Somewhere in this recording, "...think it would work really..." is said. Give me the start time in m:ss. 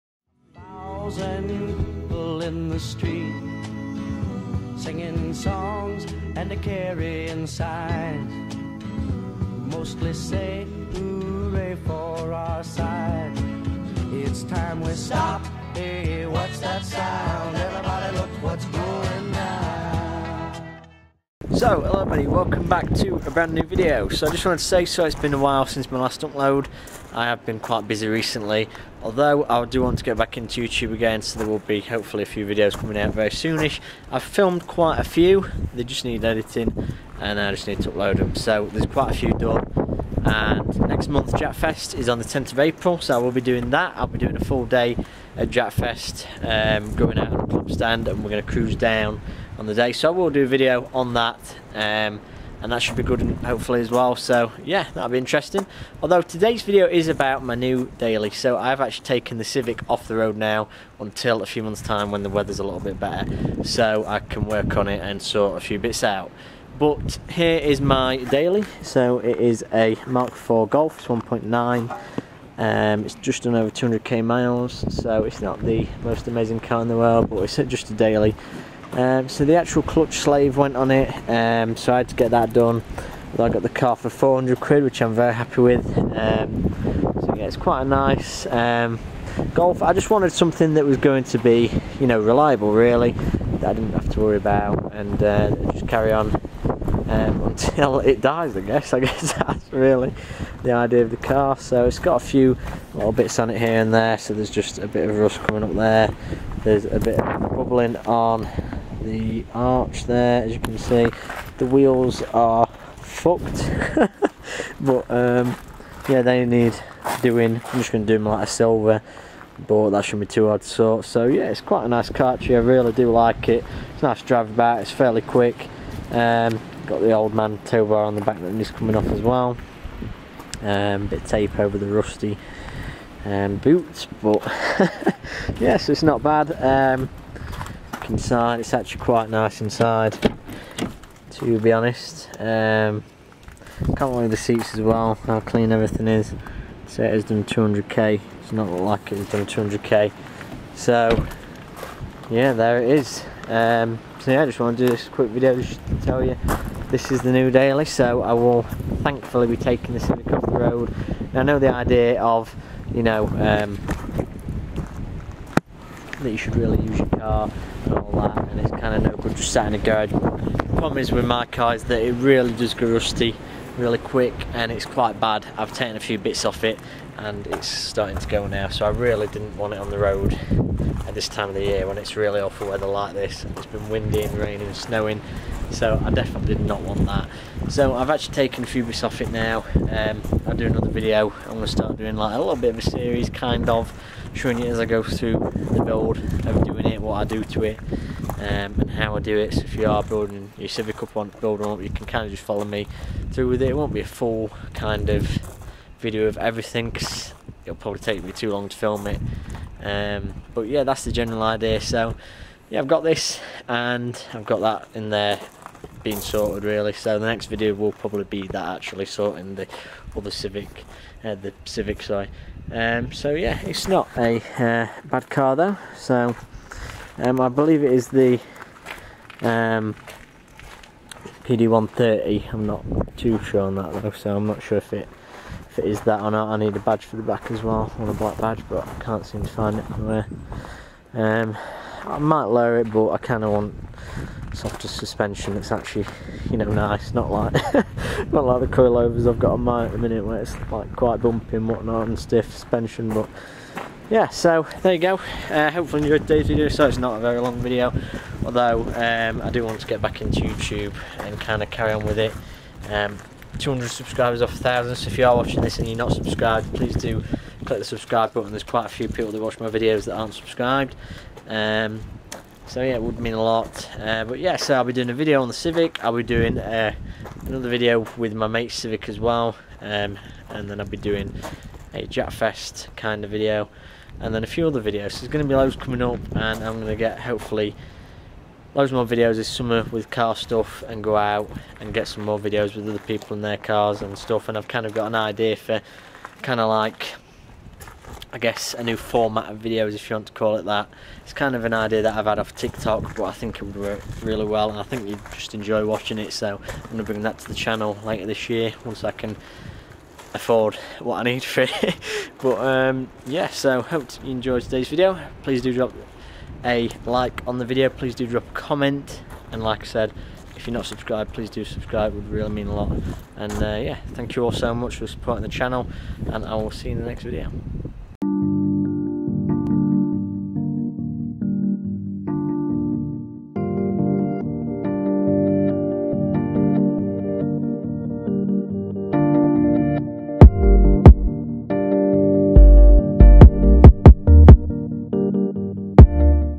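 5:03.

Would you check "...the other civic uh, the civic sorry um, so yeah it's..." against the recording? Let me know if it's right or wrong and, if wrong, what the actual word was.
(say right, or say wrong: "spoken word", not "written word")
right.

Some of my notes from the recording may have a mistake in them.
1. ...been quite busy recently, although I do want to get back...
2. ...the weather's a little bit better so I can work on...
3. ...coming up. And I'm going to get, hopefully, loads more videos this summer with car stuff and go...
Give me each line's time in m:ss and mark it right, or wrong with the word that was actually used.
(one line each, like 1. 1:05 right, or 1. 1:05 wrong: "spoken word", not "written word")
1. 0:27 right
2. 1:02 right
3. 4:45 right.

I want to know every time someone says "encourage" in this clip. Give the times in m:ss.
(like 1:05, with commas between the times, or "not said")
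not said.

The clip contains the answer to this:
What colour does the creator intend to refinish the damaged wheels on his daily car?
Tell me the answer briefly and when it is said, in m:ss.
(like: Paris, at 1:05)
silver, at 1:58.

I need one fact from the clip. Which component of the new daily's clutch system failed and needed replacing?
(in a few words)
clutch slave.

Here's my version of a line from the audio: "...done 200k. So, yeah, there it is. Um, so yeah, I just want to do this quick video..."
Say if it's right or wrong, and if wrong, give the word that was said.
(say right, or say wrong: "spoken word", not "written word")
right.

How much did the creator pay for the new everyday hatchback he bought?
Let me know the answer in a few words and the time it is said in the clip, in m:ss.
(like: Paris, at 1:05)
400 quid, at 1:24.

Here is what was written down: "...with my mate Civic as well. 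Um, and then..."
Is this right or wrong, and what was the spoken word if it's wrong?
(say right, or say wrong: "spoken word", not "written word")
right.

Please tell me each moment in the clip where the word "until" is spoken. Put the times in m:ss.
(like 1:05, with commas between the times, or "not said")
1:00, 1:37.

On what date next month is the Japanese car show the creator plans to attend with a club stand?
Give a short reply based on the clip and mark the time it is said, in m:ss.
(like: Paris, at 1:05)
10th of April, at 0:42.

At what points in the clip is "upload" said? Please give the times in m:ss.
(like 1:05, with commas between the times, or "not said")
0:26, 0:37.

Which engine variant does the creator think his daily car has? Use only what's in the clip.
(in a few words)
PD130.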